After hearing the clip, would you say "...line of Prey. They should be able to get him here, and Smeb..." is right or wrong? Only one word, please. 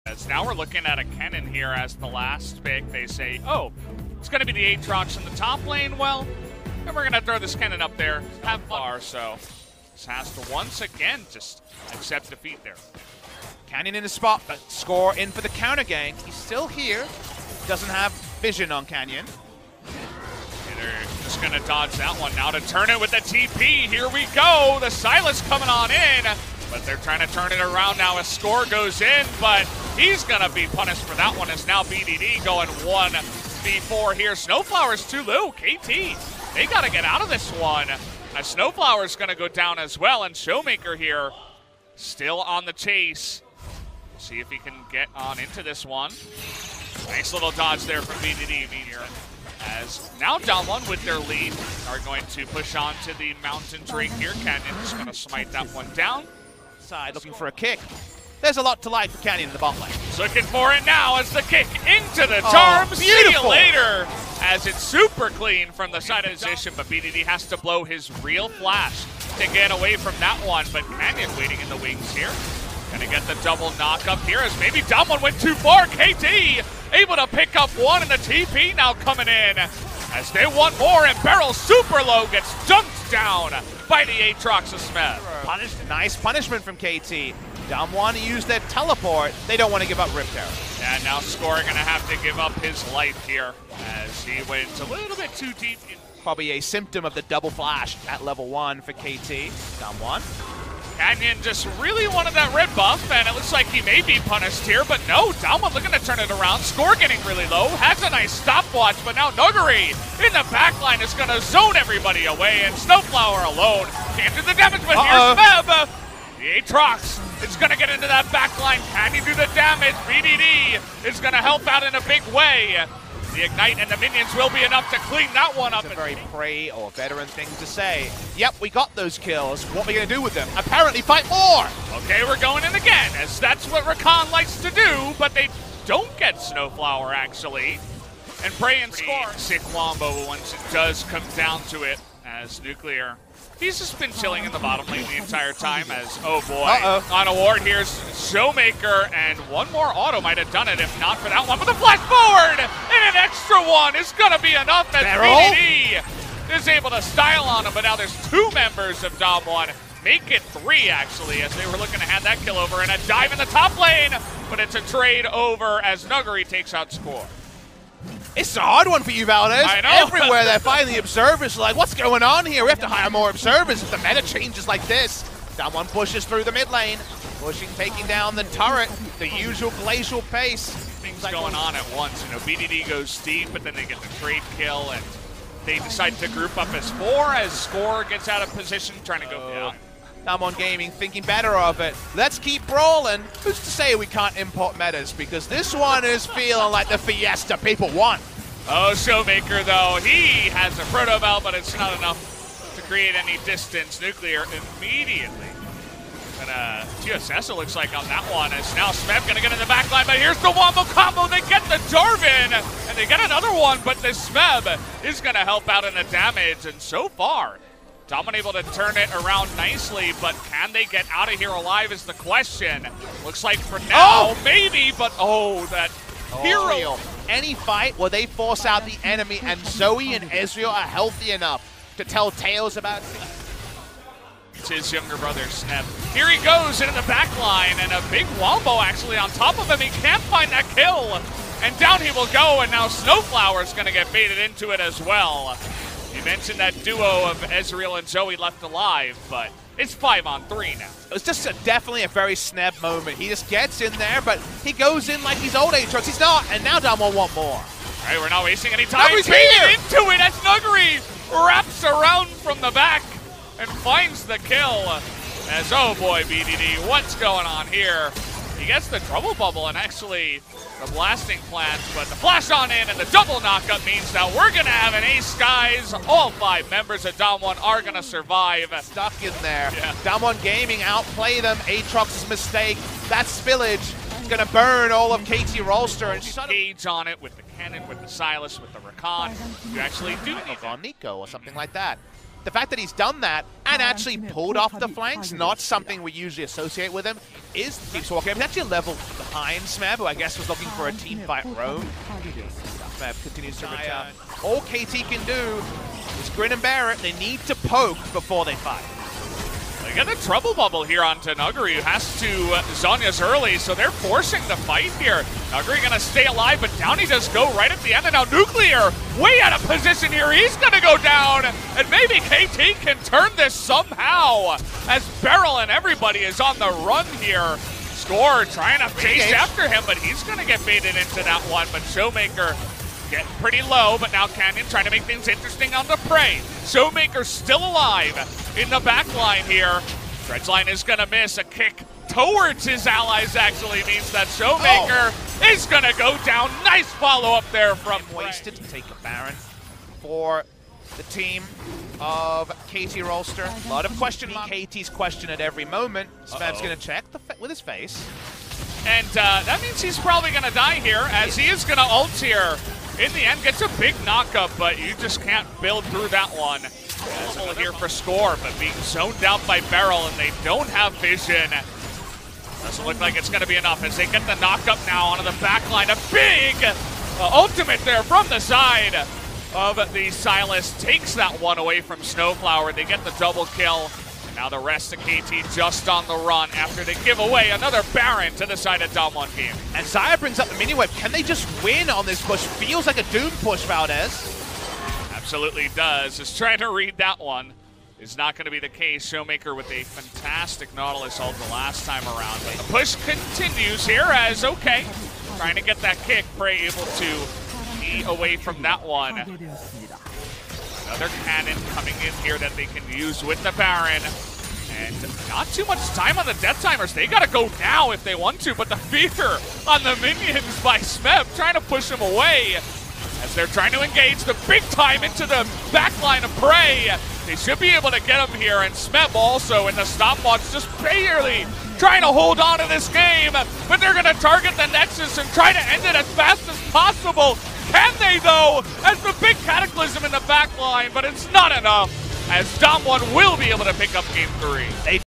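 right.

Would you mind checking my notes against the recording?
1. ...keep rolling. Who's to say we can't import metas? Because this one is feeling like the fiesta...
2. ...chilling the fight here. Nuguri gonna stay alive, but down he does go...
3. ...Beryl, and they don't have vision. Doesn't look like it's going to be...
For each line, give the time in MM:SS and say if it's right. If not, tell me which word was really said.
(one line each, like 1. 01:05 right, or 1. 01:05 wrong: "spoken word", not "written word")
1. 03:12 right
2. 05:13 wrong: "forcing", not "chilling"
3. 06:09 right.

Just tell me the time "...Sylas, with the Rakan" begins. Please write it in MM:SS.
04:48.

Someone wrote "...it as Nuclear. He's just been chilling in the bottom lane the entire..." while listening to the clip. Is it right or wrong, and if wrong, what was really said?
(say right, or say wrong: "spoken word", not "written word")
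right.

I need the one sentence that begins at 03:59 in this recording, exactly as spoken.
He can't find that kill, and down he will go, and now Snowflower is going to get baited into it as well.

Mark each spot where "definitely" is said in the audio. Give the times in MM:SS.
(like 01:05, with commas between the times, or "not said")
04:11.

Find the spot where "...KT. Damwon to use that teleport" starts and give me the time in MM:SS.
01:26.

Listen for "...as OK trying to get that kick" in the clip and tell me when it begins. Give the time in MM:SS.
06:44.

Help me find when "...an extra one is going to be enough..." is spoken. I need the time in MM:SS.
02:33.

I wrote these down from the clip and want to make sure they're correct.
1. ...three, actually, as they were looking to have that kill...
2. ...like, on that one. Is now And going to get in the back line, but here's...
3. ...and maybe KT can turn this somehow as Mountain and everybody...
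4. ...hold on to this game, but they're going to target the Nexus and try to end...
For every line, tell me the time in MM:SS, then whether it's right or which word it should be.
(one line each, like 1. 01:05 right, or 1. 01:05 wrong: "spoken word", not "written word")
1. 02:40 right
2. 03:27 wrong: "Smeb", not "And"
3. 05:21 wrong: "Beryl", not "Mountain"
4. 07:12 right.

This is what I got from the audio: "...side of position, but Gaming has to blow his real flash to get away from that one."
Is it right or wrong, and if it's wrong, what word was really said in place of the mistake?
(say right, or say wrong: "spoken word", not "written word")
wrong: "BDD", not "Gaming".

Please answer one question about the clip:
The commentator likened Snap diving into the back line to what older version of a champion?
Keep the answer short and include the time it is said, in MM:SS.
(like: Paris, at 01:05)
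old Aatrox, at 04:15.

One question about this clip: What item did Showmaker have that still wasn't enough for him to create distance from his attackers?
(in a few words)
Protobelt.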